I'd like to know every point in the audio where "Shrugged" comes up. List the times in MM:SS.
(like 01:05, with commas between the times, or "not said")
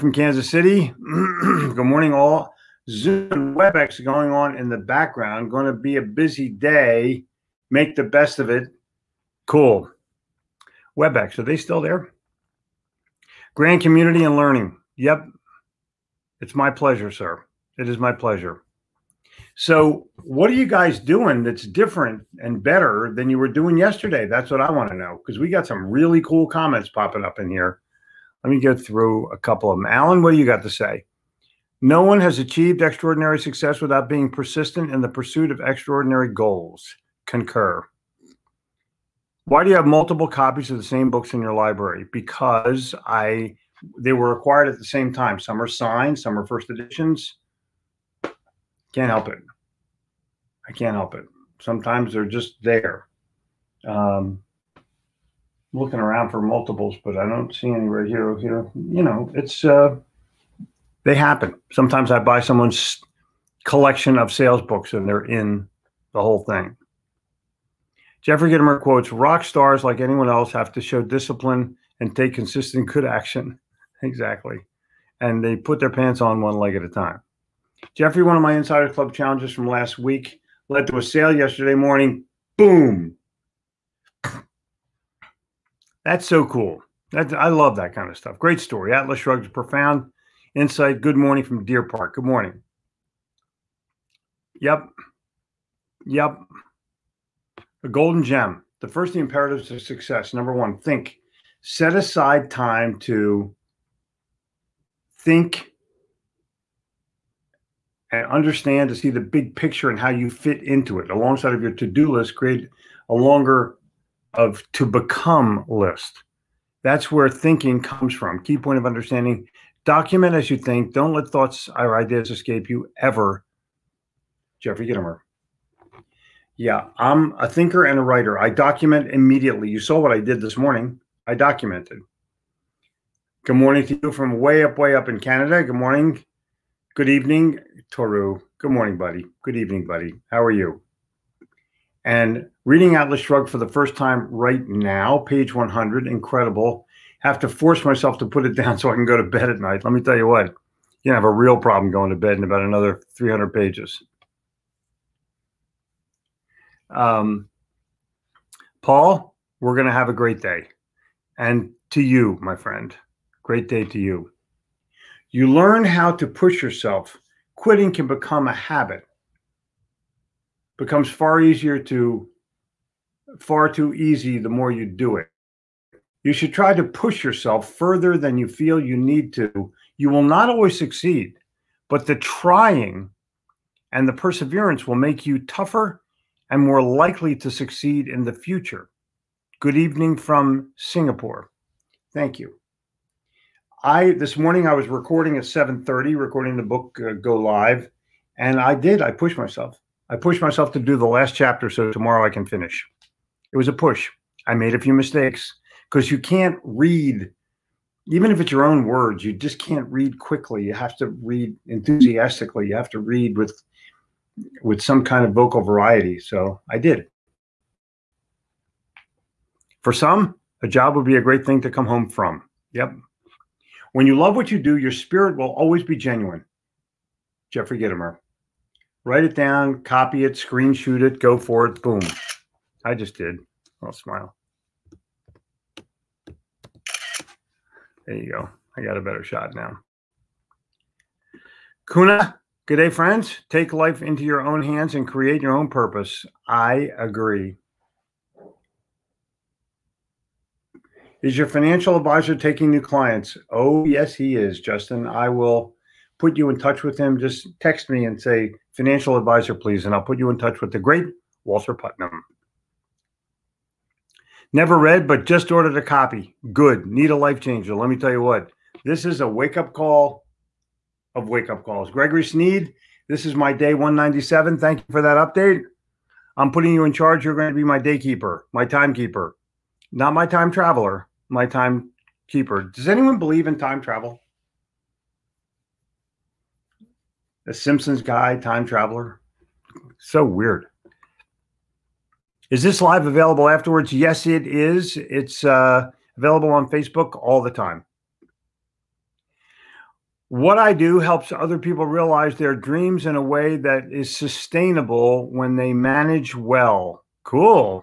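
01:29, 02:23.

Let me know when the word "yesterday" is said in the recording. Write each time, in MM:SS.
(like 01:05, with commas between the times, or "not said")
00:23, 01:21.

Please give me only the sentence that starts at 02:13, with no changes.
Good morning to you from way up, way up in Canada.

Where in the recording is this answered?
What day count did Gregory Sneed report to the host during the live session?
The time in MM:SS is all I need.
04:33.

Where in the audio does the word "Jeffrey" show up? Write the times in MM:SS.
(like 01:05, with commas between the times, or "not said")
01:08, 01:17, 02:04, 03:47.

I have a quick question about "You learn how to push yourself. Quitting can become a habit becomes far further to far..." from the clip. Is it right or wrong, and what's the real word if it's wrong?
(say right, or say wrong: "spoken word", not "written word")
wrong: "easier", not "further".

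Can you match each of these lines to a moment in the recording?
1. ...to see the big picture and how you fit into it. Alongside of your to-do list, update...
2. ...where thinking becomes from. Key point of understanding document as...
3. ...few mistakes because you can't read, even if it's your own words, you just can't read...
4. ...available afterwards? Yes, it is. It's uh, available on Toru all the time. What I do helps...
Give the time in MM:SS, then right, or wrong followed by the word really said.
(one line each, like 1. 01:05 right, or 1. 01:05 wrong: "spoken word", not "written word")
1. 01:48 wrong: "create", not "update"
2. 01:57 wrong: "comes", not "becomes"
3. 03:24 right
4. 04:53 wrong: "Facebook", not "Toru".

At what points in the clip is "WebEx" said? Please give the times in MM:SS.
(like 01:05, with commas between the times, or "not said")
00:03, 00:10.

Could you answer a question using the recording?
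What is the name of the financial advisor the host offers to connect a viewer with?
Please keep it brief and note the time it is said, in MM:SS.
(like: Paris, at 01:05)
Walter Putnam, at 04:21.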